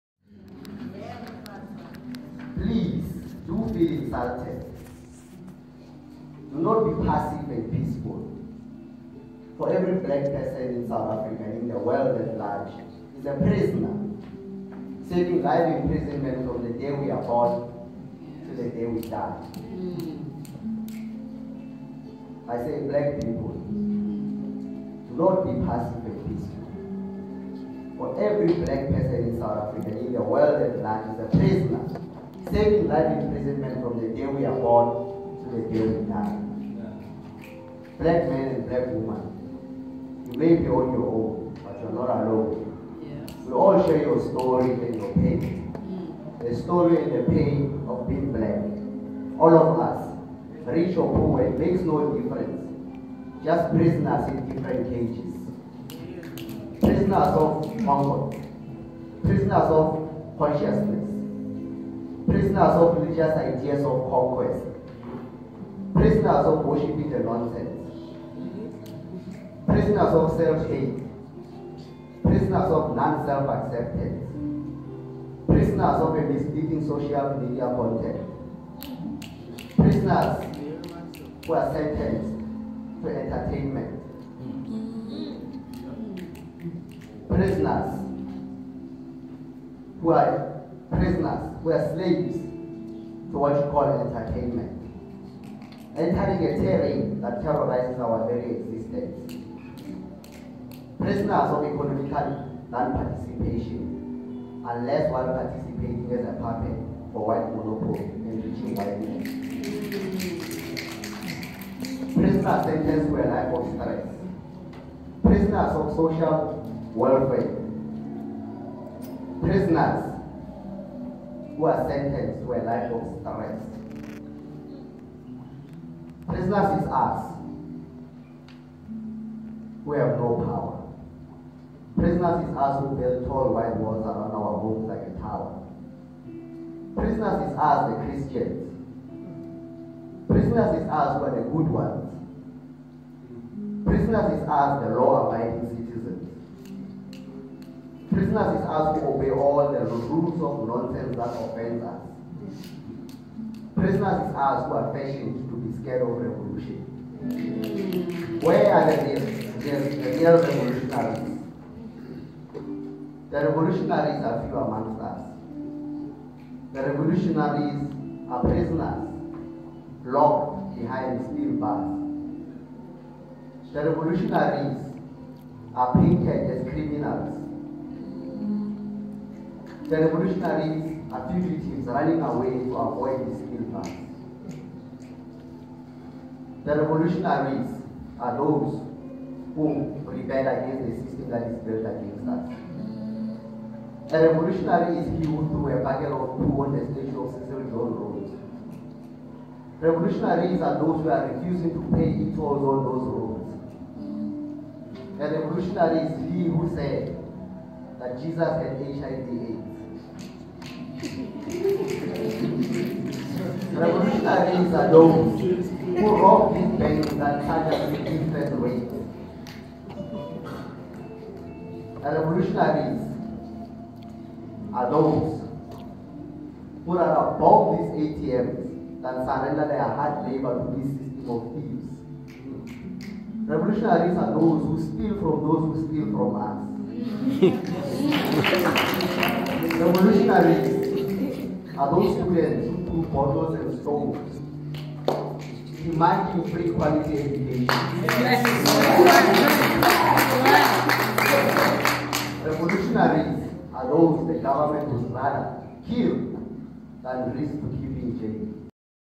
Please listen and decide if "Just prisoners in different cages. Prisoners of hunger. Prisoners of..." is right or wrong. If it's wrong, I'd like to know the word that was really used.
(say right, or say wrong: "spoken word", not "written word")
right.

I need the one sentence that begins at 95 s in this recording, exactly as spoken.
Entering a terrain that terrorizes our very existence.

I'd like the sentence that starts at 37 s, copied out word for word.
Black man and black woman, you may be on your own, but you're not alone.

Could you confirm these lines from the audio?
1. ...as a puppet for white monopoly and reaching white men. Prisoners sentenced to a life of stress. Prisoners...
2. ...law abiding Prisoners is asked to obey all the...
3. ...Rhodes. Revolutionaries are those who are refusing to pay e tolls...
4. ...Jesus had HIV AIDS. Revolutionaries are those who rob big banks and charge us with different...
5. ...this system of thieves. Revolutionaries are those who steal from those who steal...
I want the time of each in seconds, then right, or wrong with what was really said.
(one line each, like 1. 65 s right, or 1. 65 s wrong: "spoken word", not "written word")
1. 106 s right
2. 144 s right
3. 197 s right
4. 208 s right
5. 230 s right.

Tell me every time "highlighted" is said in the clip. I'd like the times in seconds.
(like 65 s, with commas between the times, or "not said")
not said.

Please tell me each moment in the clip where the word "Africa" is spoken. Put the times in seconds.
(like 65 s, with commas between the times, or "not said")
11 s, 29 s.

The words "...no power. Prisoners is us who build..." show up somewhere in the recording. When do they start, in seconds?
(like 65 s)
130 s.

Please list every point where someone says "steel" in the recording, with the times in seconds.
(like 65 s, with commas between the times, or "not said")
171 s, 183 s.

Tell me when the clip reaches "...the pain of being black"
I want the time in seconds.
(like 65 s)
47 s.